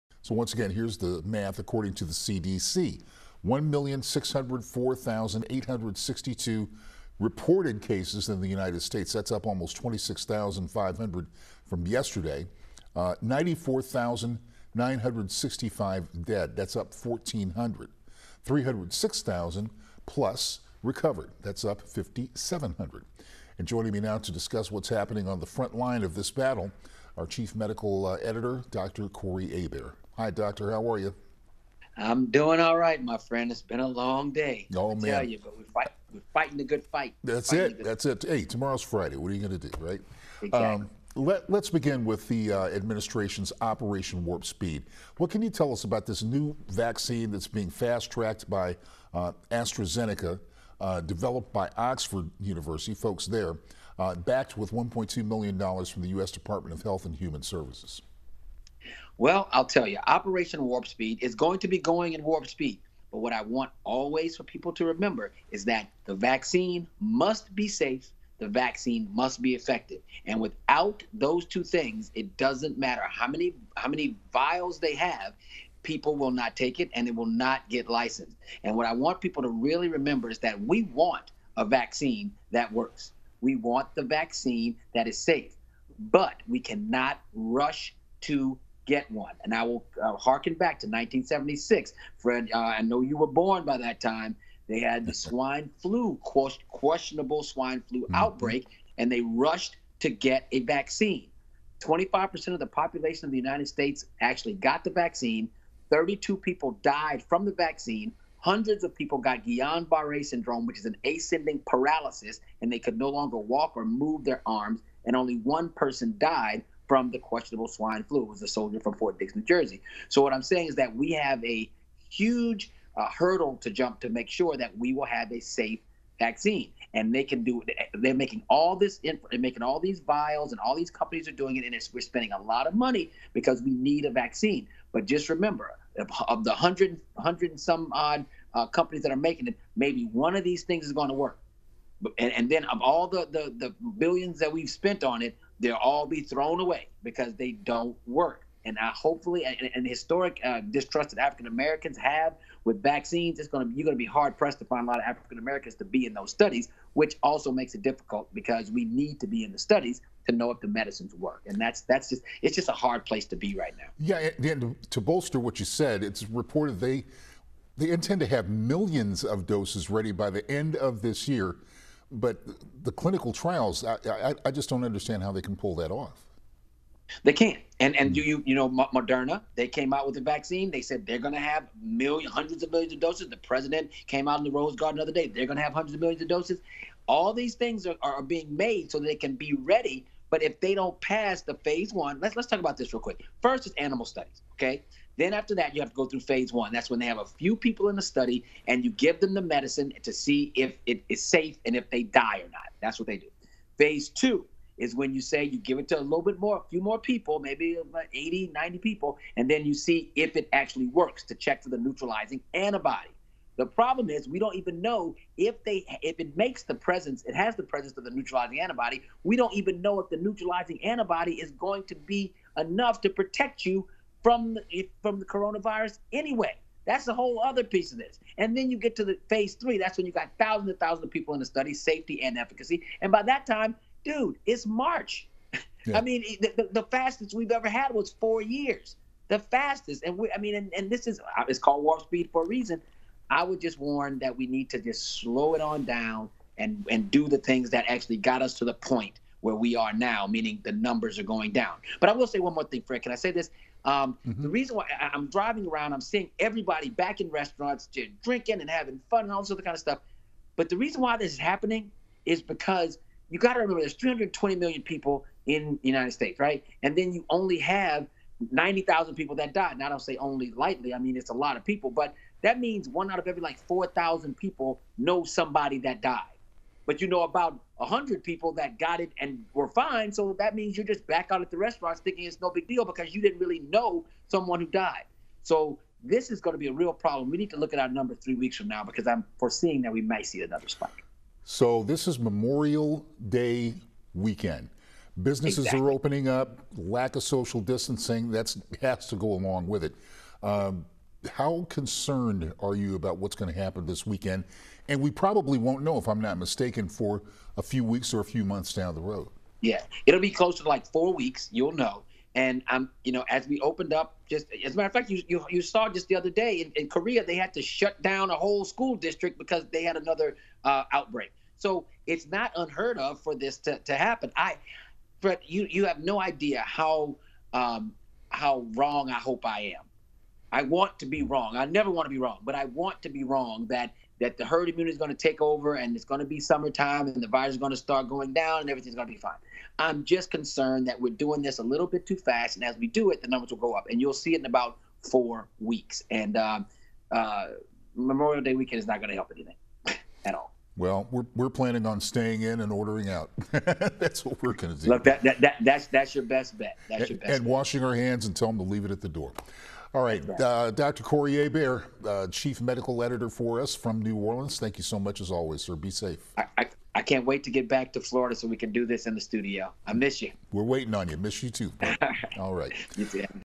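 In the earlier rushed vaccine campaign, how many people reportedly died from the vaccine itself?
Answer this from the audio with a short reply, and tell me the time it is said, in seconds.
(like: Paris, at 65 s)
32, at 105 s.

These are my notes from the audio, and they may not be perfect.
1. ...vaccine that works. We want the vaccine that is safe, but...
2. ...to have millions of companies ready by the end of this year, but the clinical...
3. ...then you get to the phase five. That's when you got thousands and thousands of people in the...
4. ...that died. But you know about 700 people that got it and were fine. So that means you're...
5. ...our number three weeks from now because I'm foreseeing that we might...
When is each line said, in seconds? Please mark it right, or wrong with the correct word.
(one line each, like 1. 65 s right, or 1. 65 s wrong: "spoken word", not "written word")
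1. 81 s right
2. 168 s wrong: "doses", not "companies"
3. 228 s wrong: "three", not "five"
4. 275 s wrong: "100", not "700"
5. 287 s right.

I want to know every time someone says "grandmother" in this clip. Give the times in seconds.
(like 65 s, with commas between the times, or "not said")
not said.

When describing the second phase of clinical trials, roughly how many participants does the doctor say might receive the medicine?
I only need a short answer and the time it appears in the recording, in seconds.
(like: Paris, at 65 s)
80 to 90, at 208 s.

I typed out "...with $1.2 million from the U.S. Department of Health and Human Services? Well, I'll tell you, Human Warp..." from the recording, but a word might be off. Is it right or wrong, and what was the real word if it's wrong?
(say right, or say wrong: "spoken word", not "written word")
wrong: "Operation", not "Human".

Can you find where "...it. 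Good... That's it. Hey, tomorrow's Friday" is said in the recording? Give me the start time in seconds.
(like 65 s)
37 s.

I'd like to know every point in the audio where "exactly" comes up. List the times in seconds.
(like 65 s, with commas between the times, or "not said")
40 s, 295 s.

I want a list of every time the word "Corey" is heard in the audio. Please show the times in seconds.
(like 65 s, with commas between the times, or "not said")
29 s, 361 s.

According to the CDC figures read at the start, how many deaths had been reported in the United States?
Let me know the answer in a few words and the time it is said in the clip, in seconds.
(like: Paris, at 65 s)
94,965, at 13 s.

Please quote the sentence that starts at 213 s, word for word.
The problem is we don't even know if they if it makes the presence, it has the presence of the neutralizing antibody.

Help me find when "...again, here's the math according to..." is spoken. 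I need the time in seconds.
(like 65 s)
0 s.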